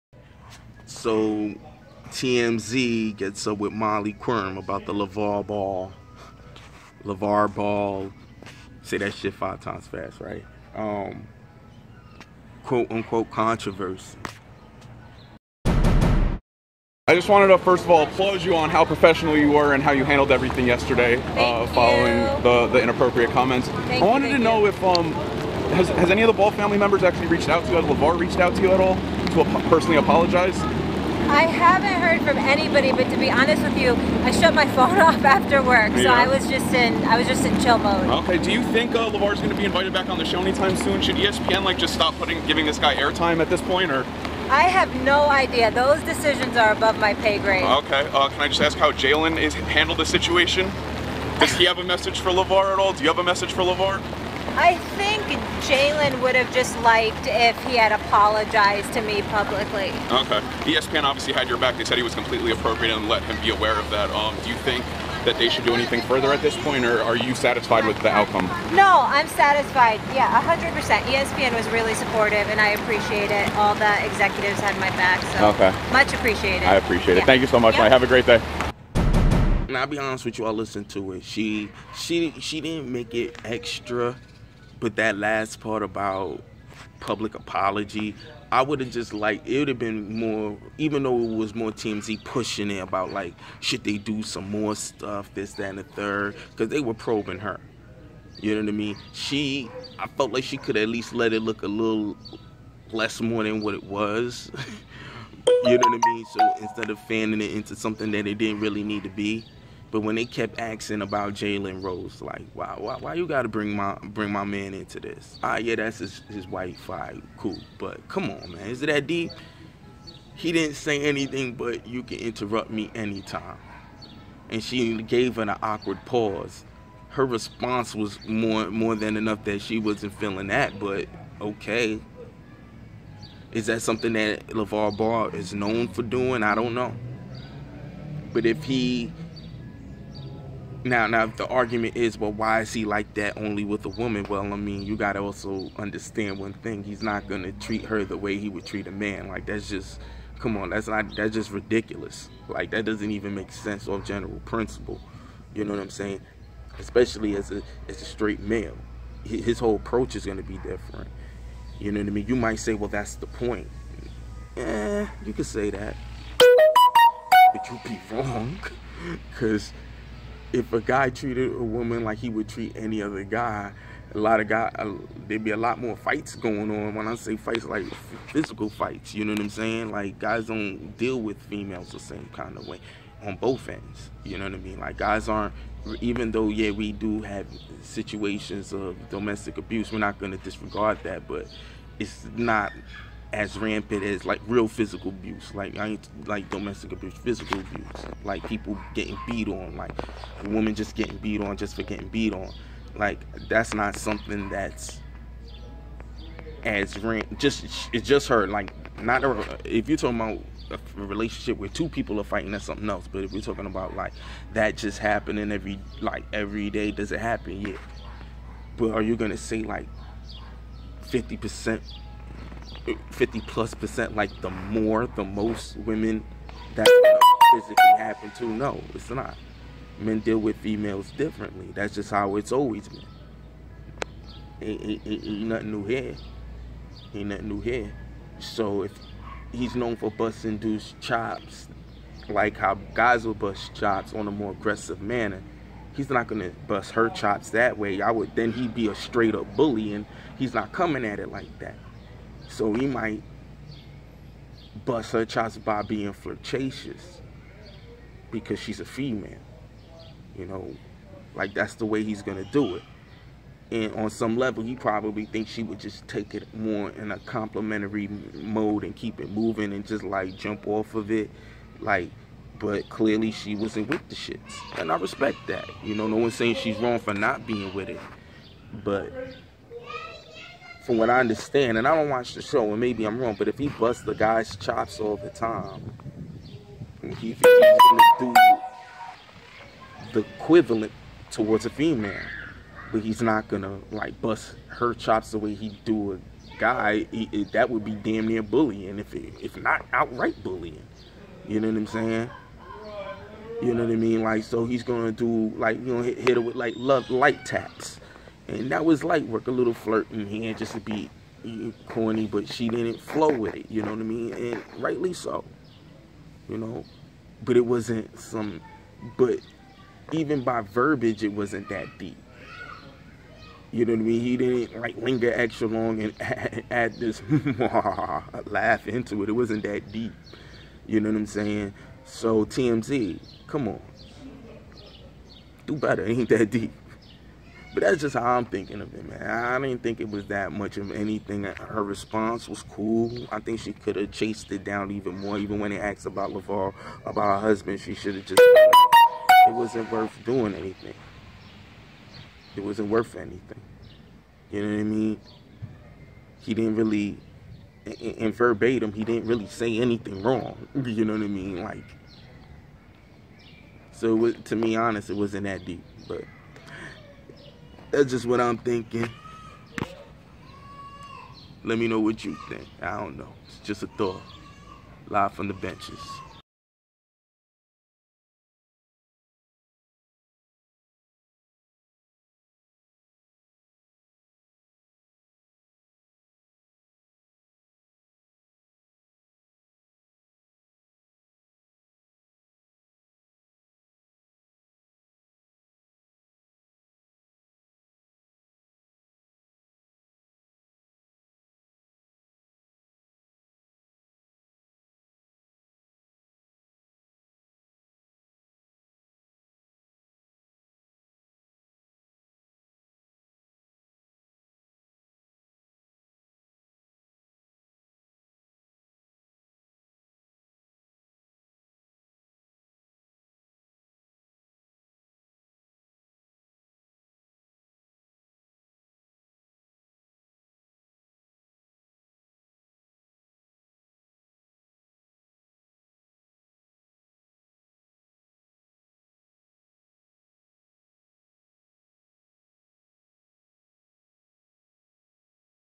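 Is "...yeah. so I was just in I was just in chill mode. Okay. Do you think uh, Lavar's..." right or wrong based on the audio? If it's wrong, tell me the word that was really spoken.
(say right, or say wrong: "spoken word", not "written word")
right.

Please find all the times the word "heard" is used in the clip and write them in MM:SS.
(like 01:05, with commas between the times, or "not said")
00:32.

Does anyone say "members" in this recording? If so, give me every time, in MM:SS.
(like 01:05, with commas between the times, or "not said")
00:26.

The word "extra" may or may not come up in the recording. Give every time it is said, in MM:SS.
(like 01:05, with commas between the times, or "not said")
01:23, 05:25.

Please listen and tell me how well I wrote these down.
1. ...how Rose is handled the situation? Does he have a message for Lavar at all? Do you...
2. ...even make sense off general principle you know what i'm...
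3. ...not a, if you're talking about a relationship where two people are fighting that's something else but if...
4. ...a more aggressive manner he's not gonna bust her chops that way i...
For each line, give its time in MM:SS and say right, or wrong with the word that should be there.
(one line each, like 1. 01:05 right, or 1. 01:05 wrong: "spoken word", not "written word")
1. 00:48 wrong: "Jalen", not "Rose"
2. 02:33 right
3. 03:29 right
4. 04:04 right.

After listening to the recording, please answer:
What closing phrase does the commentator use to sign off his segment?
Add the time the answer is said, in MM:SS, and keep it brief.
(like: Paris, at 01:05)
Live from the benches, at 06:15.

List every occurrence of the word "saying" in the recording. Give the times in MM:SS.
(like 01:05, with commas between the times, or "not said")
02:35, 02:59, 04:36, 05:01, 05:31.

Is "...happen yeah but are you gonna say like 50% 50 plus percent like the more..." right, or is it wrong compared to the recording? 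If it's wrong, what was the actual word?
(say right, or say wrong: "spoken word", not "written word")
right.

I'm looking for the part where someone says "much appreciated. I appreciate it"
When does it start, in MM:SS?
01:15.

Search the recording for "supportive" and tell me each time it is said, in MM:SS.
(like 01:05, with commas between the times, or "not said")
01:11.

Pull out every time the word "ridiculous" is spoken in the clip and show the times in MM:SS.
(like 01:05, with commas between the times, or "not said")
02:31.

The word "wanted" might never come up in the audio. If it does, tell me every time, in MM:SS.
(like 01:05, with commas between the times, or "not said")
00:17, 00:24.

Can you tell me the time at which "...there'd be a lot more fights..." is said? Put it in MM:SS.
02:55.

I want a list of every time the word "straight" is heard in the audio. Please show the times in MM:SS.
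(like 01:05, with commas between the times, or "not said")
02:38, 04:08.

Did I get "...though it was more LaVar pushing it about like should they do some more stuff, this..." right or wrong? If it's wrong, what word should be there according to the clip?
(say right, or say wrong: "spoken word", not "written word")
wrong: "TMZ", not "LaVar".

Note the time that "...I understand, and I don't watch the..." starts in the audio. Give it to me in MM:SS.
04:41.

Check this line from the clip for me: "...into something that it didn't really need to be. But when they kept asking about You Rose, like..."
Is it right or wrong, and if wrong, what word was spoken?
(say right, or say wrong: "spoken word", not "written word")
wrong: "Jalen", not "You".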